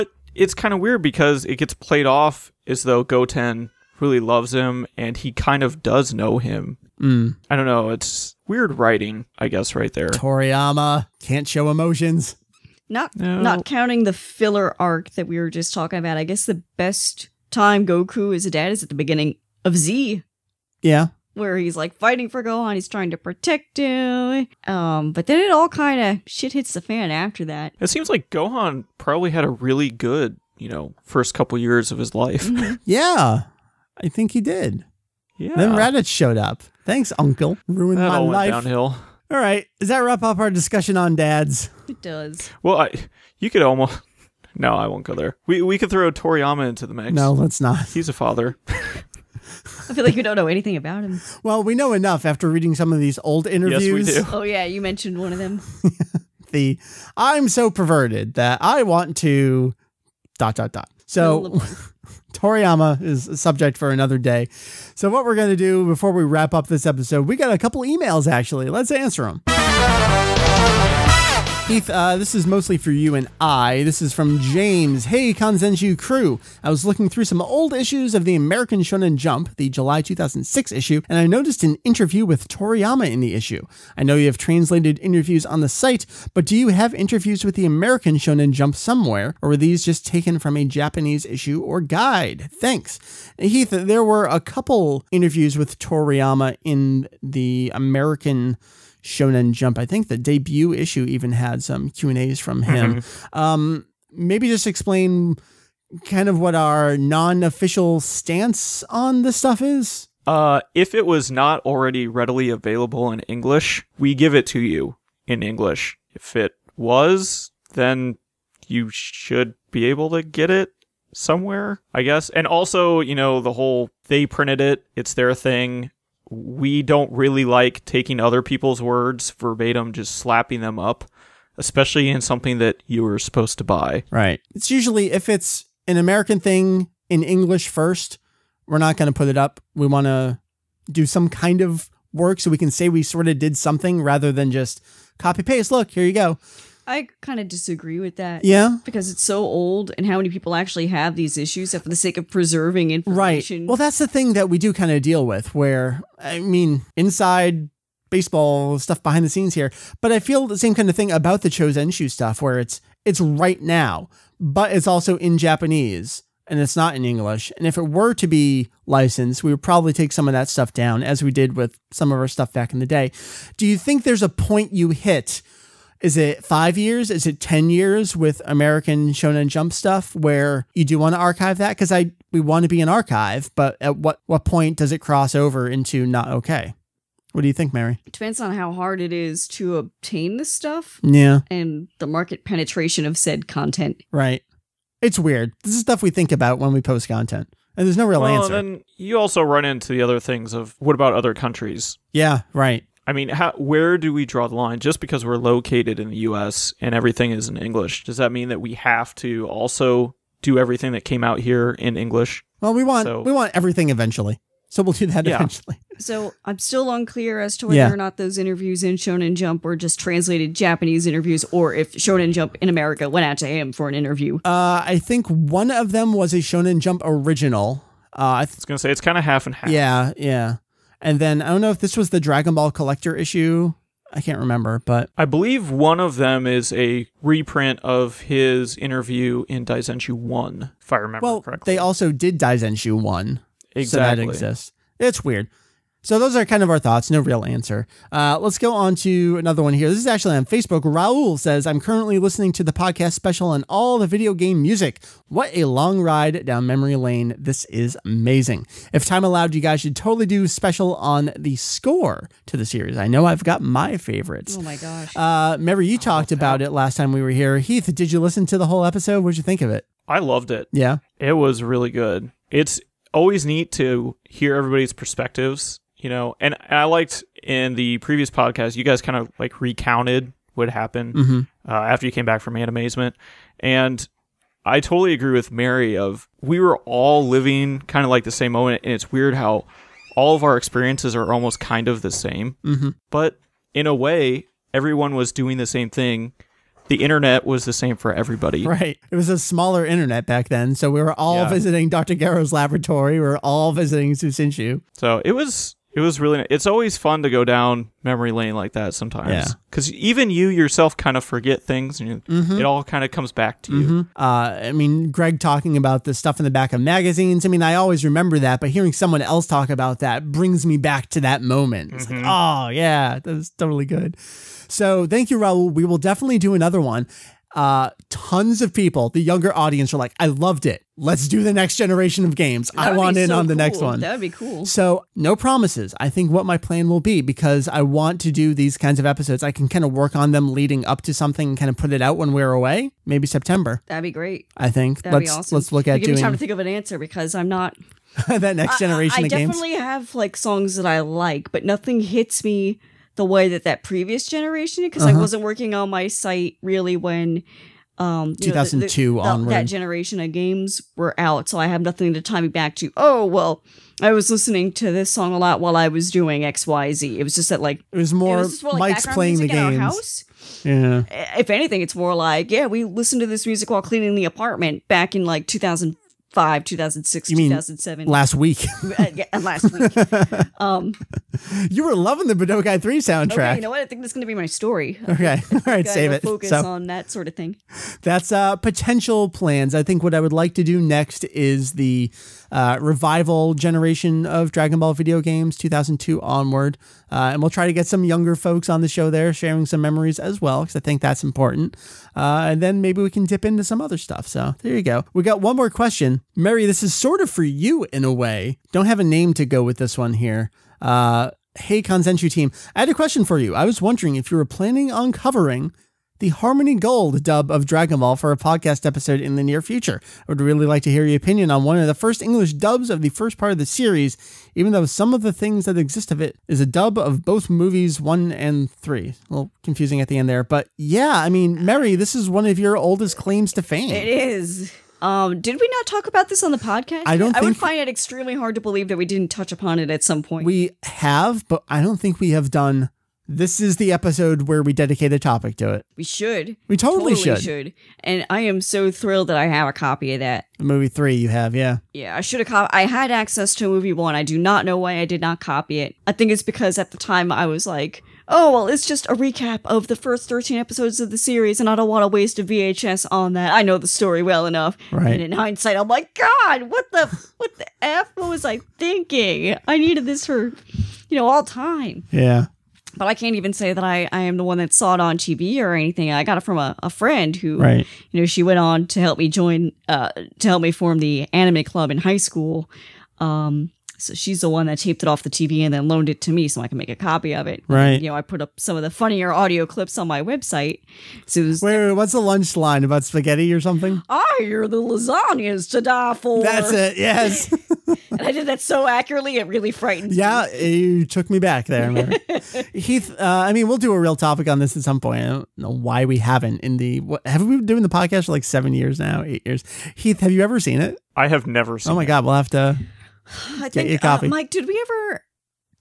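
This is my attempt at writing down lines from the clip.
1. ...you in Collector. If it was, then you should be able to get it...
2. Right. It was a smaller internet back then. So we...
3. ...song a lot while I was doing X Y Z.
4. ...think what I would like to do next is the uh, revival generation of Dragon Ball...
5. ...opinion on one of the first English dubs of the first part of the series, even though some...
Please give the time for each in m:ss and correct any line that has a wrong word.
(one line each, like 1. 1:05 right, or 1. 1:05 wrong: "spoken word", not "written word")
1. 1:54 wrong: "English", not "Collector"
2. 4:58 right
3. 6:05 right
4. 6:29 right
5. 7:01 right.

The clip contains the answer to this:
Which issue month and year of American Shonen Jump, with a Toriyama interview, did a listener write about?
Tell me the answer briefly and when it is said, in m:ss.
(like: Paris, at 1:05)
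July 2006, at 1:19.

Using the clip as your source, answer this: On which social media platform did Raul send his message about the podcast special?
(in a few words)
Facebook.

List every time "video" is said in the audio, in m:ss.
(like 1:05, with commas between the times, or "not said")
4:14, 6:34.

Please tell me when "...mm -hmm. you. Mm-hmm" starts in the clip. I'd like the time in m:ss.
5:13.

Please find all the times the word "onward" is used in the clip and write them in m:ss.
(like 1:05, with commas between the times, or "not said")
5:59, 6:36.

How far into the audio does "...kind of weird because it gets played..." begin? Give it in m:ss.
0:00.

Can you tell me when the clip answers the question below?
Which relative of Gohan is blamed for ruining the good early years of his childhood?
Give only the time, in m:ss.
0:35.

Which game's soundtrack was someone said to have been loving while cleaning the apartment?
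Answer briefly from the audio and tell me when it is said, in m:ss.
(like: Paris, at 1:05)
Budokai 3, at 6:22.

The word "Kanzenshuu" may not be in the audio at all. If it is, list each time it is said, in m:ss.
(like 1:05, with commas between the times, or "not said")
1:15, 6:51.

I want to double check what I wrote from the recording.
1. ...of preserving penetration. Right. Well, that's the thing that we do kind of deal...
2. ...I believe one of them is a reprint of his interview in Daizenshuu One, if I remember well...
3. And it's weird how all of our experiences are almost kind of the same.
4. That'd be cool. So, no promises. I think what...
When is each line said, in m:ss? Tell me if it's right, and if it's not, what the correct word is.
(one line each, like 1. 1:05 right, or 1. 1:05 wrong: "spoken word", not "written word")
1. 2:32 wrong: "information", not "penetration"
2. 3:55 right
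3. 4:48 right
4. 5:33 right.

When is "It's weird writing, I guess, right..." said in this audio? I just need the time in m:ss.
0:07.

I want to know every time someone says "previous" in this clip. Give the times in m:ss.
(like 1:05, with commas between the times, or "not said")
4:37, 5:53.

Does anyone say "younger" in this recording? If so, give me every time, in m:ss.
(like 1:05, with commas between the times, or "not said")
5:29, 6:38.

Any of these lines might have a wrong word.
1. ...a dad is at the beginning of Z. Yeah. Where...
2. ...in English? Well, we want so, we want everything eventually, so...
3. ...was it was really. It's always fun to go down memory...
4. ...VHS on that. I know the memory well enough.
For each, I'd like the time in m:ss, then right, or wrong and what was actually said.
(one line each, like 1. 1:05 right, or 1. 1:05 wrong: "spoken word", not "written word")
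1. 0:18 right
2. 3:31 right
3. 5:05 right
4. 7:42 wrong: "story", not "memory".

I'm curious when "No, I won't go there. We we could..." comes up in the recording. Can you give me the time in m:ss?
0:44.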